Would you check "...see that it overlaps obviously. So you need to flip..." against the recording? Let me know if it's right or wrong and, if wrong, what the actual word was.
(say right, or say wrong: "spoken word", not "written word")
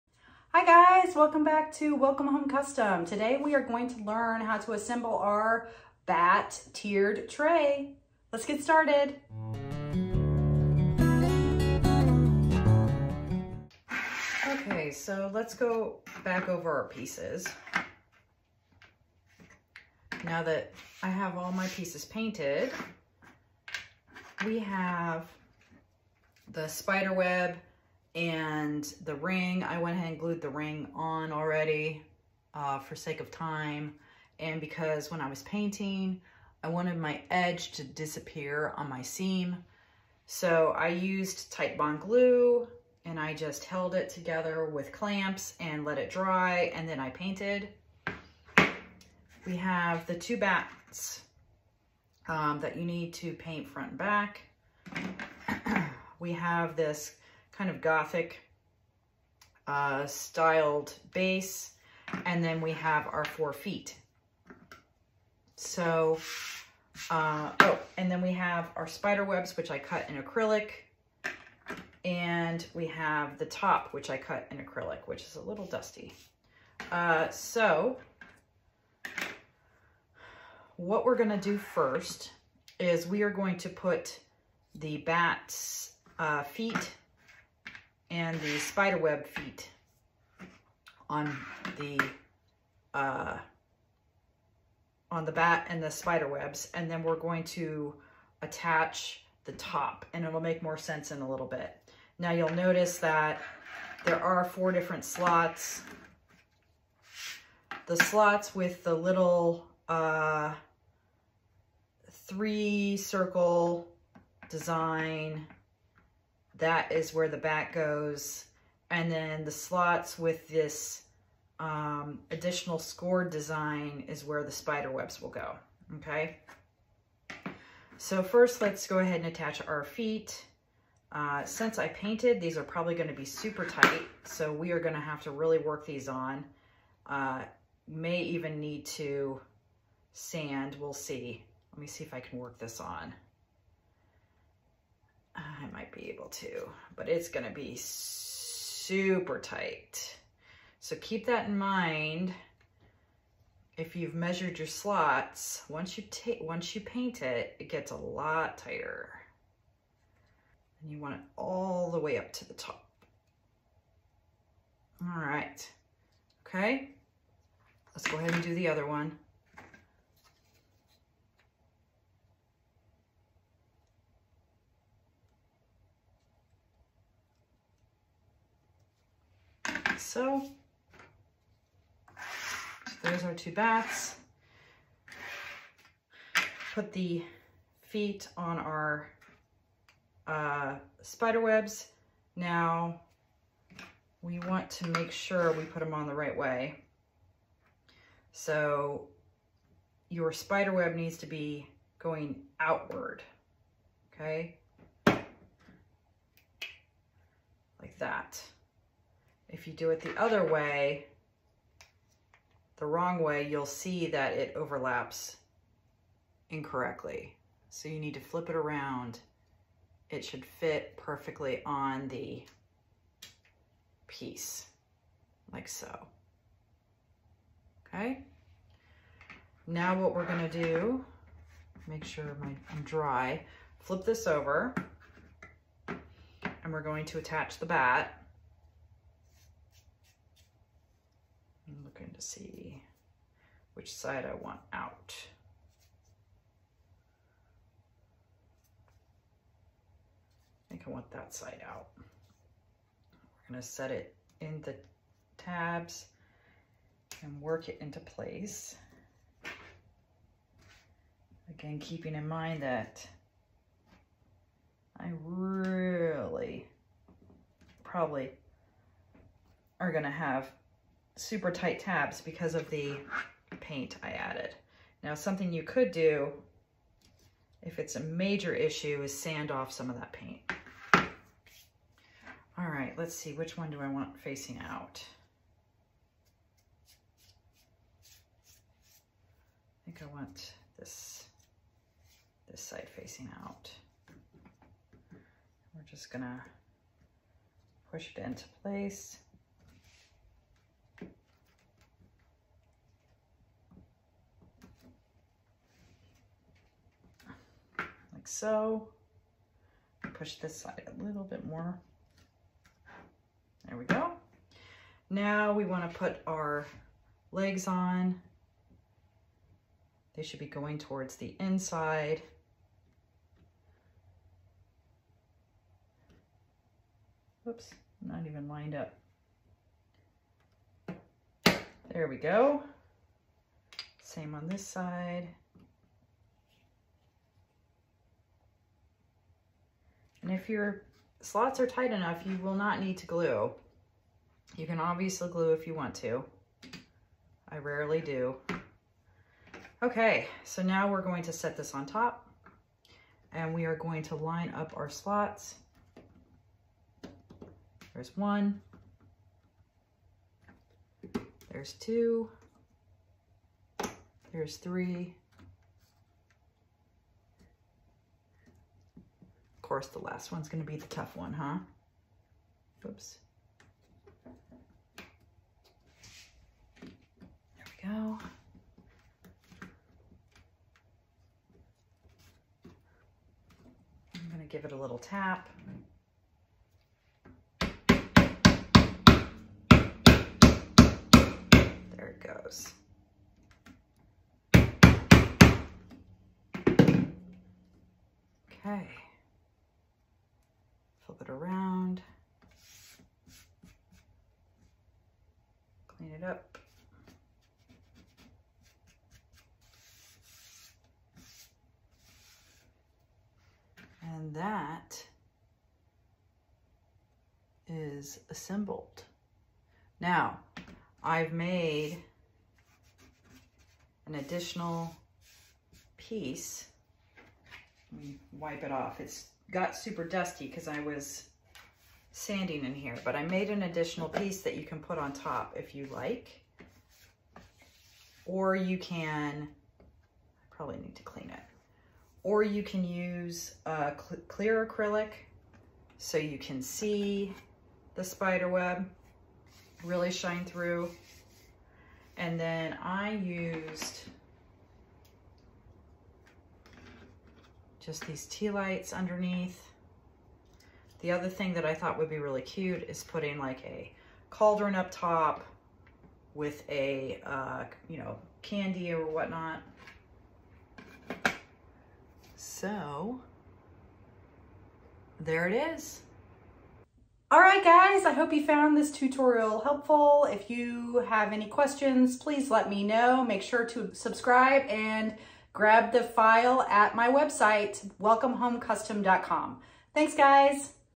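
wrong: "incorrectly", not "obviously".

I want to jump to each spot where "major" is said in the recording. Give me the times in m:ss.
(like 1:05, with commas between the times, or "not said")
4:37.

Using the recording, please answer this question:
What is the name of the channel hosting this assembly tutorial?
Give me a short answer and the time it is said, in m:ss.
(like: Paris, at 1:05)
Welcome Home Custom, at 0:01.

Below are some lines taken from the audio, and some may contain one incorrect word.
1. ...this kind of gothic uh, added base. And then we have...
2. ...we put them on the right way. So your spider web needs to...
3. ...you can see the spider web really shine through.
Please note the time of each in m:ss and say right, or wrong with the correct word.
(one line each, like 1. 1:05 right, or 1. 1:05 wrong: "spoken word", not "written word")
1. 0:56 wrong: "styled", not "added"
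2. 3:15 right
3. 7:26 right.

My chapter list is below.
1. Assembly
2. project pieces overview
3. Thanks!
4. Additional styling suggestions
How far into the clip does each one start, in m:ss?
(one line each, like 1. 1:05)
1. 1:22
2. 0:14
3. 7:57
4. 7:15.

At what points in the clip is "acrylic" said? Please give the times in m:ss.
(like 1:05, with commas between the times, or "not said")
1:10, 1:14, 7:24.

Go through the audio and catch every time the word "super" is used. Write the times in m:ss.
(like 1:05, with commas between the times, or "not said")
2:13, 2:27, 4:31, 7:09.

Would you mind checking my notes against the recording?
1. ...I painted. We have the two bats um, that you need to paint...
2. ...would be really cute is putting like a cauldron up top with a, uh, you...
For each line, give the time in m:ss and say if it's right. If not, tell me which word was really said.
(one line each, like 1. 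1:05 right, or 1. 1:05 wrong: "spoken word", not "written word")
1. 0:46 right
2. 7:41 right.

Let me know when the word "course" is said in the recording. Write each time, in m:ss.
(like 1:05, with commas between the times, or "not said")
6:09.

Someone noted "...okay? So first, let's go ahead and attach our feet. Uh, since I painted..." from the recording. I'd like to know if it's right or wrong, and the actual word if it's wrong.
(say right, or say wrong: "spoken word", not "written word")
right.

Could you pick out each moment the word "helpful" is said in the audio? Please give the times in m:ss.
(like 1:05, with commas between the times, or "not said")
7:59.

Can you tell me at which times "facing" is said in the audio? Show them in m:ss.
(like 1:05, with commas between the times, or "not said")
4:44, 4:52.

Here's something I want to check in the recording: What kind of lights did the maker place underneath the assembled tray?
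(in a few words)
tea lights.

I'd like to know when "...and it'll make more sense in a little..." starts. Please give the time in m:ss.
1:40.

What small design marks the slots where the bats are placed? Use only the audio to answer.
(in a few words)
three circle design.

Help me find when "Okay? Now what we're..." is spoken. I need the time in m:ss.
3:47.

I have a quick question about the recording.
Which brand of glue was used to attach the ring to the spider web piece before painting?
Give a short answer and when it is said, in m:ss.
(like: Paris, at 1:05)
Tight Bond, at 0:41.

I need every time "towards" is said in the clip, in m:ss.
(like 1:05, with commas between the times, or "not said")
5:20.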